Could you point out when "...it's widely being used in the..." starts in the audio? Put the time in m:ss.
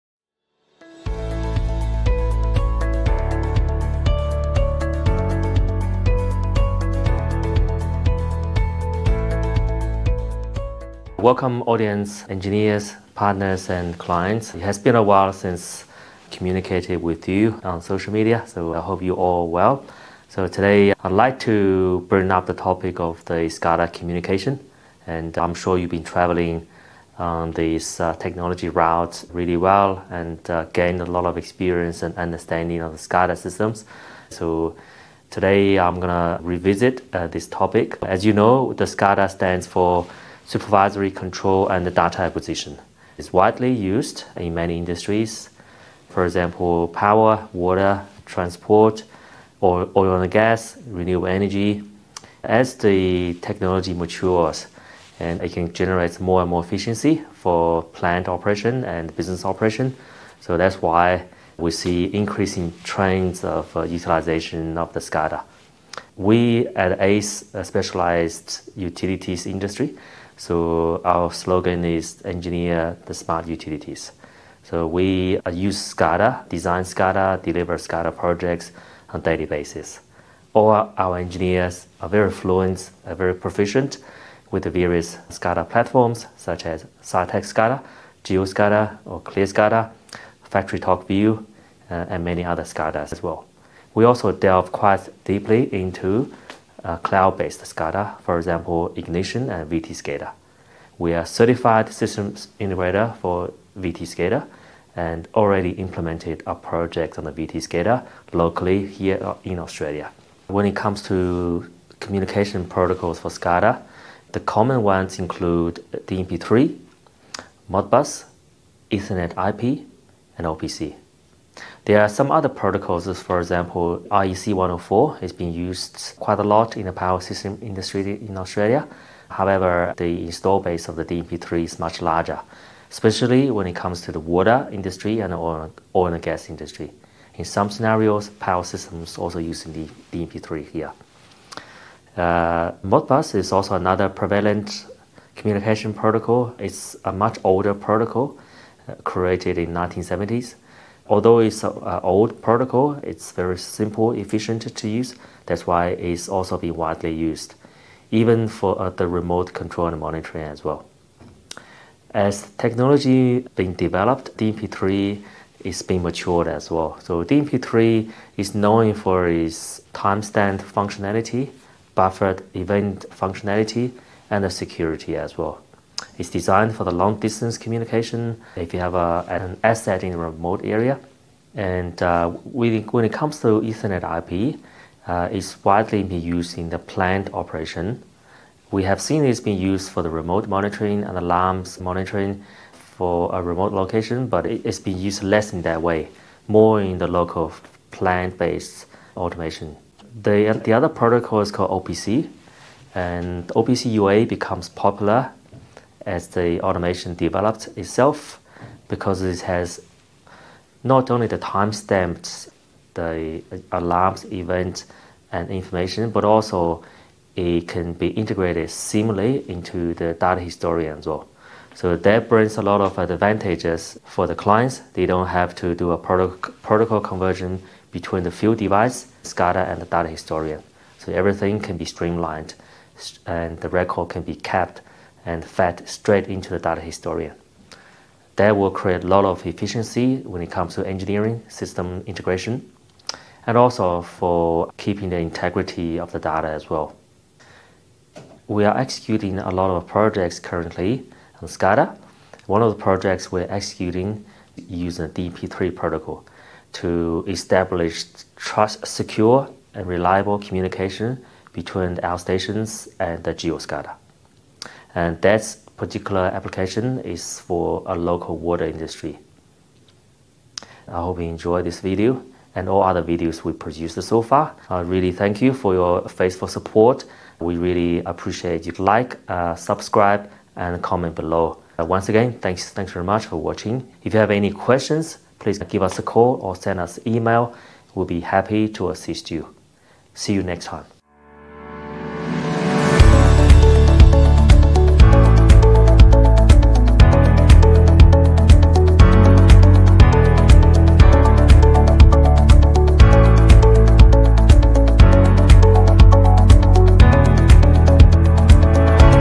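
3:05.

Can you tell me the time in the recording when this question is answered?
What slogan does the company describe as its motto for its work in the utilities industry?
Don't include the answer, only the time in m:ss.
1:12.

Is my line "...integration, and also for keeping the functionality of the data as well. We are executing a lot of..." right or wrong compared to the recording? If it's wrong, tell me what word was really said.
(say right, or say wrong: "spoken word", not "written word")
wrong: "integrity", not "functionality".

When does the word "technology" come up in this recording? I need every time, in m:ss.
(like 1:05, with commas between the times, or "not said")
0:28, 0:53, 2:42.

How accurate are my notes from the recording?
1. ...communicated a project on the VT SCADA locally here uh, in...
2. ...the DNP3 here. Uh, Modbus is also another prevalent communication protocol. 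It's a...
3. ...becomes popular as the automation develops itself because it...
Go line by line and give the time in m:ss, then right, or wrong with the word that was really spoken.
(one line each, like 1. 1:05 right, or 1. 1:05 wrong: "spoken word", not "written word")
1. 1:45 wrong: "implemented", not "communicated"
2. 2:19 right
3. 3:24 right.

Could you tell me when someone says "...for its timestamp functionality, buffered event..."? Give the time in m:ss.
2:48.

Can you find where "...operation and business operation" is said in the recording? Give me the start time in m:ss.
0:58.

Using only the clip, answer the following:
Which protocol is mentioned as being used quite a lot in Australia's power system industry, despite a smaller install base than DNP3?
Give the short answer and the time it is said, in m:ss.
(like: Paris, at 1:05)
IEC 104, at 2:04.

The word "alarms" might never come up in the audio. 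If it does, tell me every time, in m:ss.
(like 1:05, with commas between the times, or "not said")
3:11, 3:33.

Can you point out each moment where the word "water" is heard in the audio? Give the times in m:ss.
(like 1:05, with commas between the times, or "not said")
0:47, 2:14, 4:28.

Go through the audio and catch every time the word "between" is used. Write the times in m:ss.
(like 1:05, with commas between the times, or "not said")
3:47, 4:21.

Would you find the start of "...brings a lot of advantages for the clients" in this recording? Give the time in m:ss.
3:42.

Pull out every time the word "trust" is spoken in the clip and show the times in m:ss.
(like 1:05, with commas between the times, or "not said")
4:18.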